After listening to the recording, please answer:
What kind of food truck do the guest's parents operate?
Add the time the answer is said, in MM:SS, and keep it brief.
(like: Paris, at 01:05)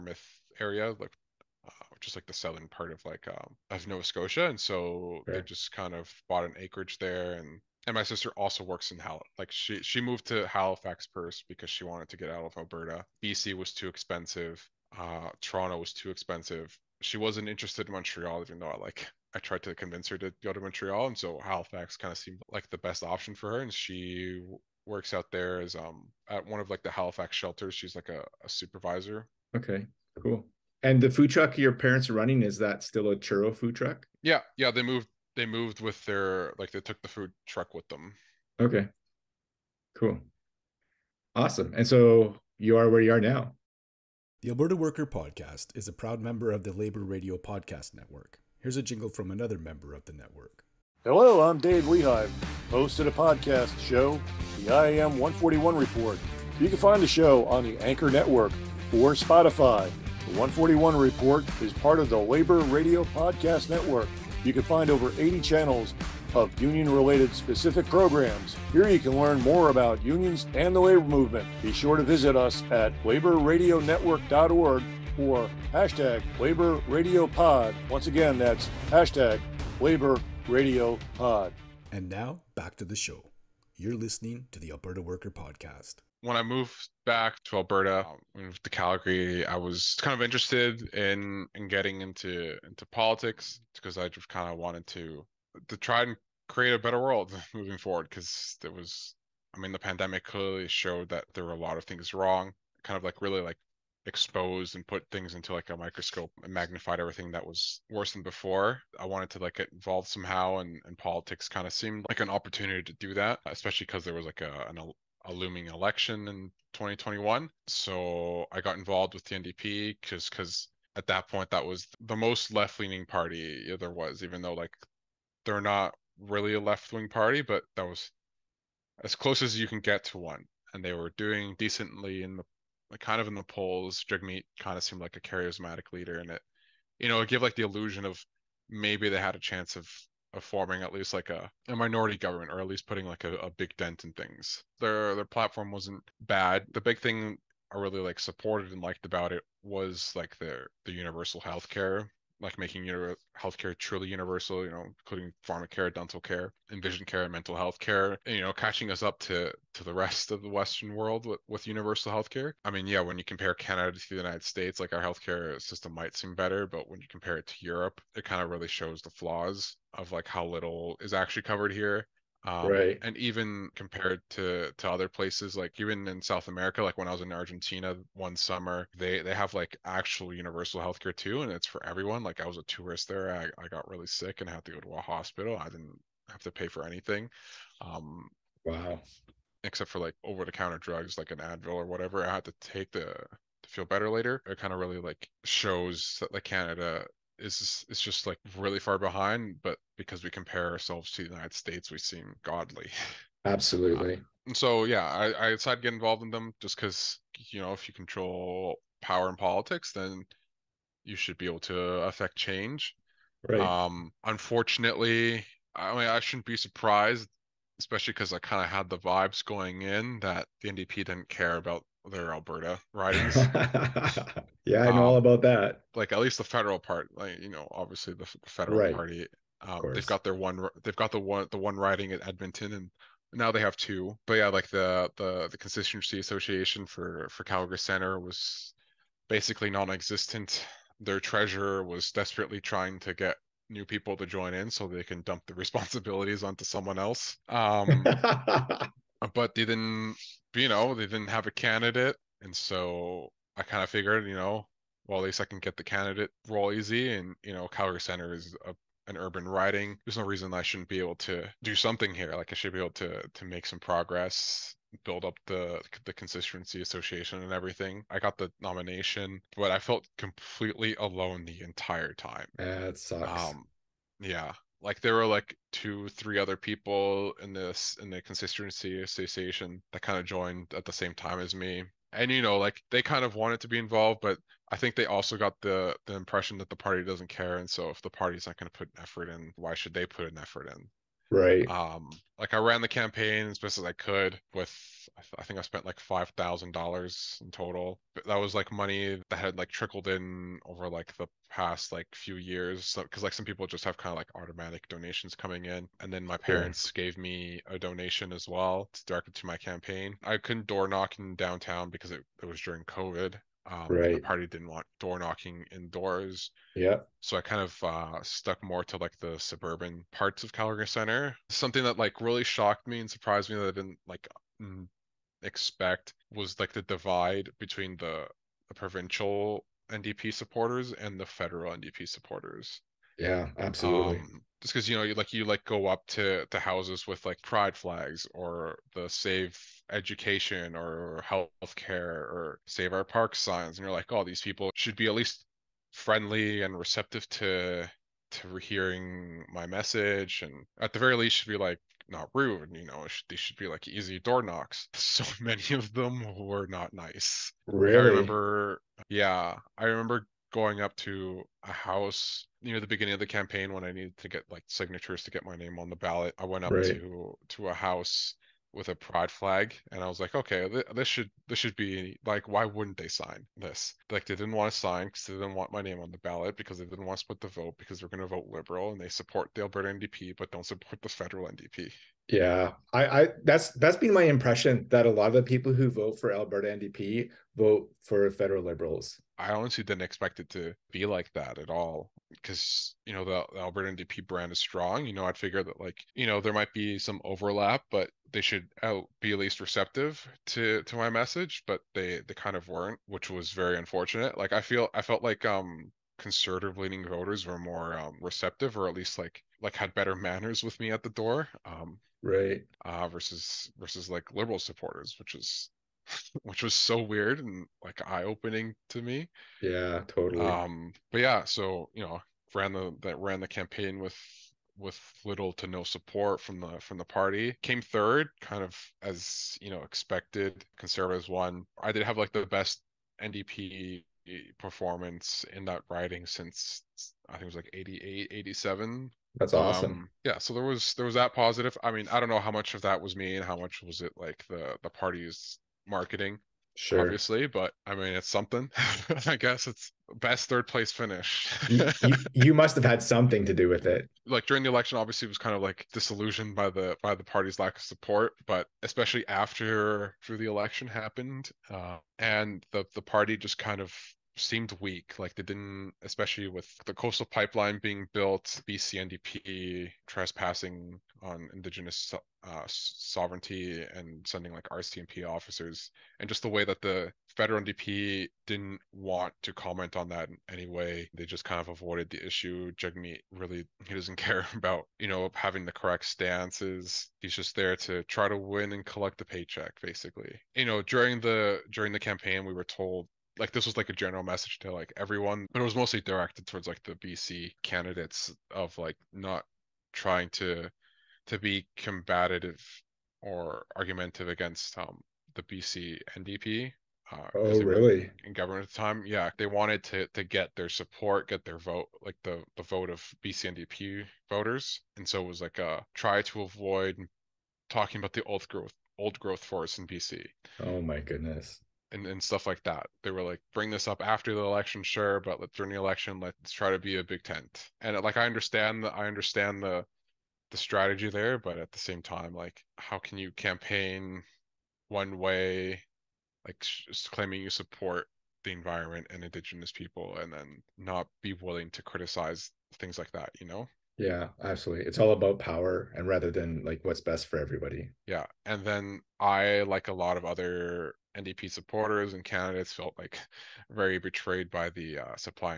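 Churro, at 00:33.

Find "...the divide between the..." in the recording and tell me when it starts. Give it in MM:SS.
05:26.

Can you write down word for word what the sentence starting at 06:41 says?
But they they kind of weren't, which was very unfortunate.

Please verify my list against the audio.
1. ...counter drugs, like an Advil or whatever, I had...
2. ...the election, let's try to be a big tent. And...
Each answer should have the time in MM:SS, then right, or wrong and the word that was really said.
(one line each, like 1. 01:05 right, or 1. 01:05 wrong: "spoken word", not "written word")
1. 03:10 right
2. 08:45 right.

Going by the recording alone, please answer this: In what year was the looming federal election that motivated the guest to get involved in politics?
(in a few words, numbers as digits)
2021.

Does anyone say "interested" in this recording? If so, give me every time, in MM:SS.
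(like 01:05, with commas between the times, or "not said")
00:17, 01:30.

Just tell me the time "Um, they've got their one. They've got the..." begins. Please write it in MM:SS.
03:49.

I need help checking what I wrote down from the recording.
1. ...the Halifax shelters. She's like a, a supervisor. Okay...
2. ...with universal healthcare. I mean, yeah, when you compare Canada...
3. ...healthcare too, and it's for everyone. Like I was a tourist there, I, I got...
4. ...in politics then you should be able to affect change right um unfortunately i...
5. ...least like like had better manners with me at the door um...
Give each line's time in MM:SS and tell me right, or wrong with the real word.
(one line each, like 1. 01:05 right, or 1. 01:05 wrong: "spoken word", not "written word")
1. 00:26 right
2. 02:41 right
3. 03:00 right
4. 03:29 right
5. 06:48 right.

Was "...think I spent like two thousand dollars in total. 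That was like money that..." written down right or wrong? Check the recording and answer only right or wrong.
wrong.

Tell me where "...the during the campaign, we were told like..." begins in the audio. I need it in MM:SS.
08:11.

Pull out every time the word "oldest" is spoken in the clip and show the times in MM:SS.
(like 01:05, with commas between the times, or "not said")
not said.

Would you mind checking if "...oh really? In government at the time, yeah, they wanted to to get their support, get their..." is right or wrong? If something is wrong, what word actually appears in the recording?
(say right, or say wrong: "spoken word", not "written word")
right.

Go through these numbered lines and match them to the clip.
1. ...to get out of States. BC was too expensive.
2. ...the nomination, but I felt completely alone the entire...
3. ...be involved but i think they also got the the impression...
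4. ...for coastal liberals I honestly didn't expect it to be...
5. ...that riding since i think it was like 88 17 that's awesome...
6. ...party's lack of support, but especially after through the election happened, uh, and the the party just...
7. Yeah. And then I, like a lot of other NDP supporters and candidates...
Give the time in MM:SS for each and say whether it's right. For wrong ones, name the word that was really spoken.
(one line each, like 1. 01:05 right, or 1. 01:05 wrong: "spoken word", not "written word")
1. 00:12 wrong: "Alberta", not "States"
2. 04:28 right
3. 04:43 right
4. 06:28 wrong: "federal", not "coastal"
5. 07:15 wrong: "87", not "17"
6. 07:37 right
7. 09:08 right.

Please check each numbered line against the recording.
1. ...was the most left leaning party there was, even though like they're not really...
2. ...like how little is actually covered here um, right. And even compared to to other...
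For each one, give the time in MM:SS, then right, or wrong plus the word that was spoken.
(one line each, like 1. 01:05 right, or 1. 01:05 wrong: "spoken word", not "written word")
1. 02:01 right
2. 02:50 right.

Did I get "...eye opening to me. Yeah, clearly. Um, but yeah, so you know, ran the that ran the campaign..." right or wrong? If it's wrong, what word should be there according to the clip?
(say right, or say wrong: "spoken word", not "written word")
wrong: "totally", not "clearly".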